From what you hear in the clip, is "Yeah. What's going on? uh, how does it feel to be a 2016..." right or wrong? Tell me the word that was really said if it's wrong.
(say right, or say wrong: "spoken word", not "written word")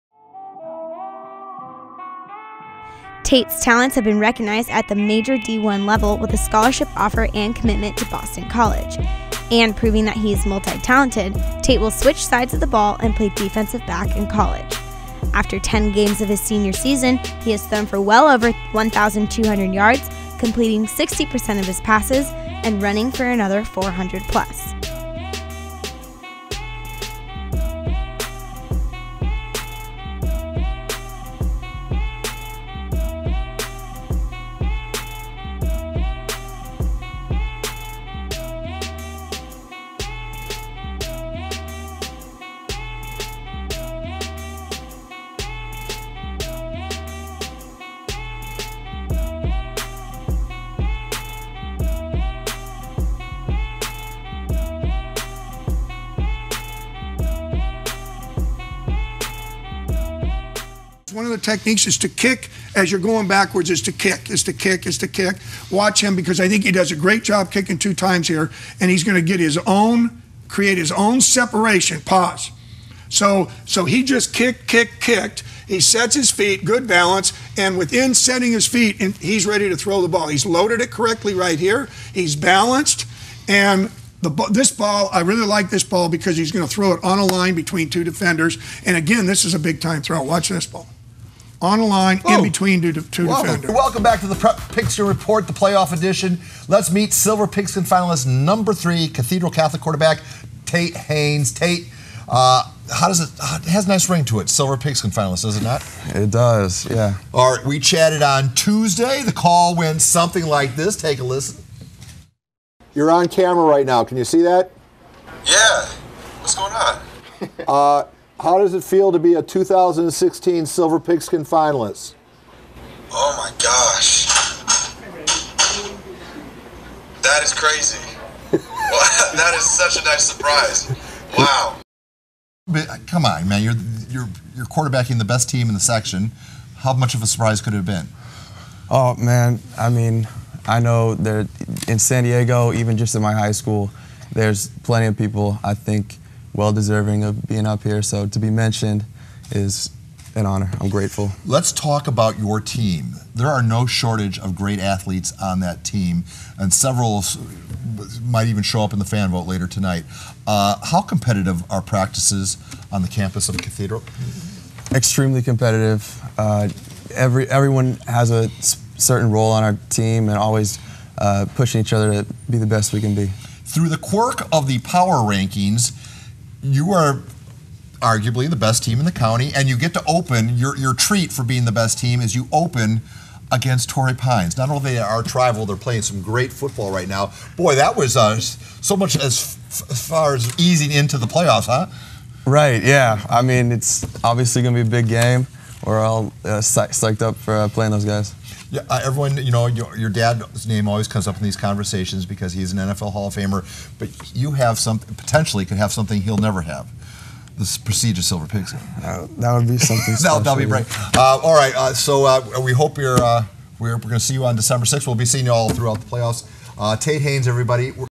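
right.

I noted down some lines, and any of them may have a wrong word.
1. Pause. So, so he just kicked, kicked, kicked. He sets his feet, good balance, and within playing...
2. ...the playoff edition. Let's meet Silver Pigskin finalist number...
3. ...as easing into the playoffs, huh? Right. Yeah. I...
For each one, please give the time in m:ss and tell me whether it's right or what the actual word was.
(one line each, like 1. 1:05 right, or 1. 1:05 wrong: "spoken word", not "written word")
1. 1:12 wrong: "setting", not "playing"
2. 1:35 right
3. 3:10 right.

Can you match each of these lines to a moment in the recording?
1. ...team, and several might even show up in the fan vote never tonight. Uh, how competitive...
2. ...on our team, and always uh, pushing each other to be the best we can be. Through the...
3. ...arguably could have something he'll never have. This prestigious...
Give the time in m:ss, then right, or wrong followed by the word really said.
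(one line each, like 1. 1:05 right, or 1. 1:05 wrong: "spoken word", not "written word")
1. 2:35 wrong: "later", not "never"
2. 2:49 right
3. 3:24 wrong: "potentially", not "arguably".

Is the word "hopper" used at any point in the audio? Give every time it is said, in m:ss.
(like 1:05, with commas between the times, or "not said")
not said.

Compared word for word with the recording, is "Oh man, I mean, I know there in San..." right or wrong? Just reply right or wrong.
right.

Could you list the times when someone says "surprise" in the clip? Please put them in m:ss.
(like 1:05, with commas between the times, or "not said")
2:10, 2:17.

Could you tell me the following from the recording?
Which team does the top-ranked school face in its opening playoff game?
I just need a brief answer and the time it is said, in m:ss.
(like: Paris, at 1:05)
Torrey Pines, at 3:03.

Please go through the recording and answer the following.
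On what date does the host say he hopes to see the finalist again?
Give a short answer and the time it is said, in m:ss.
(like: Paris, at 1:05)
December 6, at 3:34.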